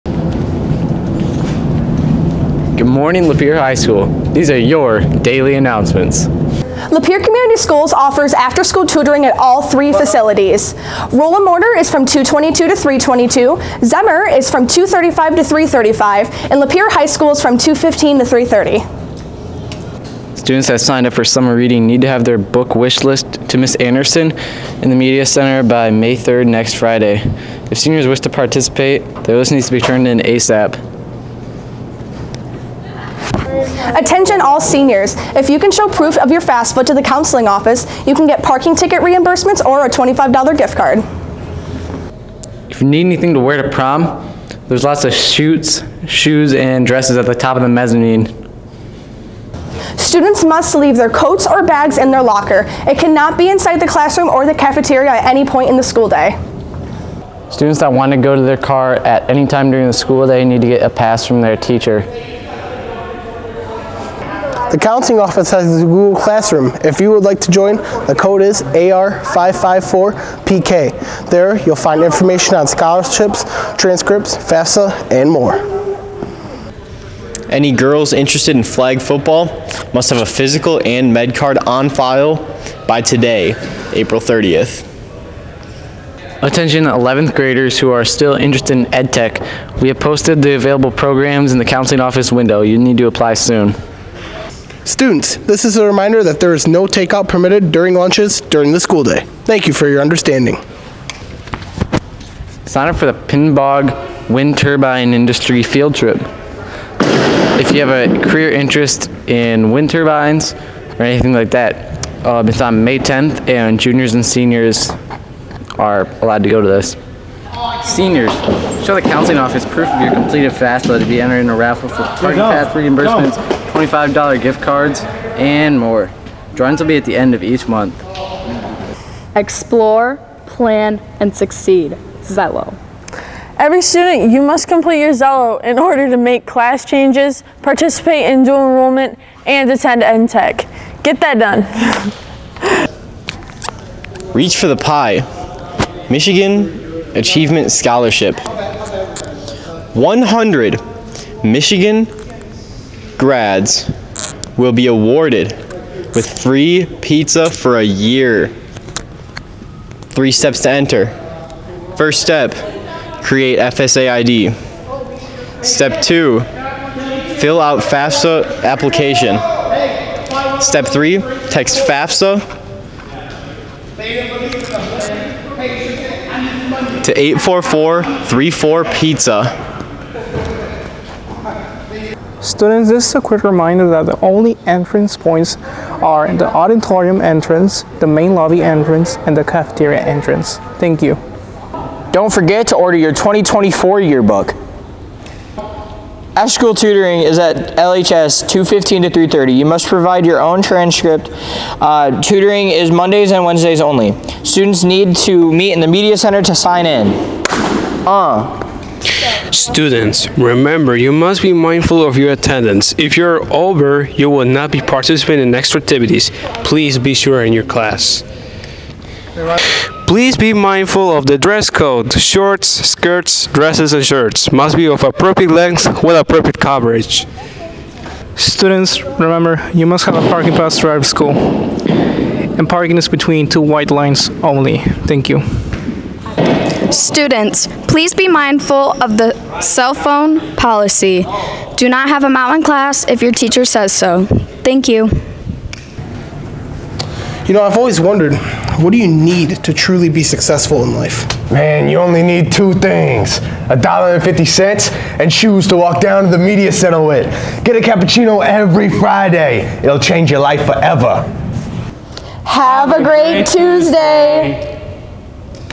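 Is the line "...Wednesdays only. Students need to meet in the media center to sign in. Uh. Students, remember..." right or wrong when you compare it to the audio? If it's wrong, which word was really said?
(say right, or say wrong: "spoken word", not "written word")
right.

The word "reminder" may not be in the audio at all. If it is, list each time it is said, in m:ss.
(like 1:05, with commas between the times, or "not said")
1:35, 3:03.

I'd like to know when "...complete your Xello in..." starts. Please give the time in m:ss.
2:14.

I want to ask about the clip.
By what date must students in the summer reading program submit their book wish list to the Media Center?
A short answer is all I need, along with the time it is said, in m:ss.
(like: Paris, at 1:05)
May 3rd, at 0:25.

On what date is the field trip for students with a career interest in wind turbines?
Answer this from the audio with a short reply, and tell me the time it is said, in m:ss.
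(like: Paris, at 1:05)
May 10th, at 1:52.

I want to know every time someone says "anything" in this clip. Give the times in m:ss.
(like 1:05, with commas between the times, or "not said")
0:43, 1:51.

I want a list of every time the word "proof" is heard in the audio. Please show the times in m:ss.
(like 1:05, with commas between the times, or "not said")
0:35, 1:59.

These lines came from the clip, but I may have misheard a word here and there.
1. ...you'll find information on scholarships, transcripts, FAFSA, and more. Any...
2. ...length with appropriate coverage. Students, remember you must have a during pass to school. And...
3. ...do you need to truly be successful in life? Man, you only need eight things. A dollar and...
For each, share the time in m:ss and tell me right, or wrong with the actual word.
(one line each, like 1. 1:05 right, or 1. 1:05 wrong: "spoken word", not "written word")
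1. 1:11 right
2. 3:45 wrong: "parking", not "during"
3. 4:08 wrong: "two", not "eight".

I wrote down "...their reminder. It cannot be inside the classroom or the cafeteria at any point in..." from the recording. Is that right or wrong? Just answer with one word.
wrong.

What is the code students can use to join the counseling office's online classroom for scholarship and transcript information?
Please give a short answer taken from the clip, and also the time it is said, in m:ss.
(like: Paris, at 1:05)
AR554PK, at 1:08.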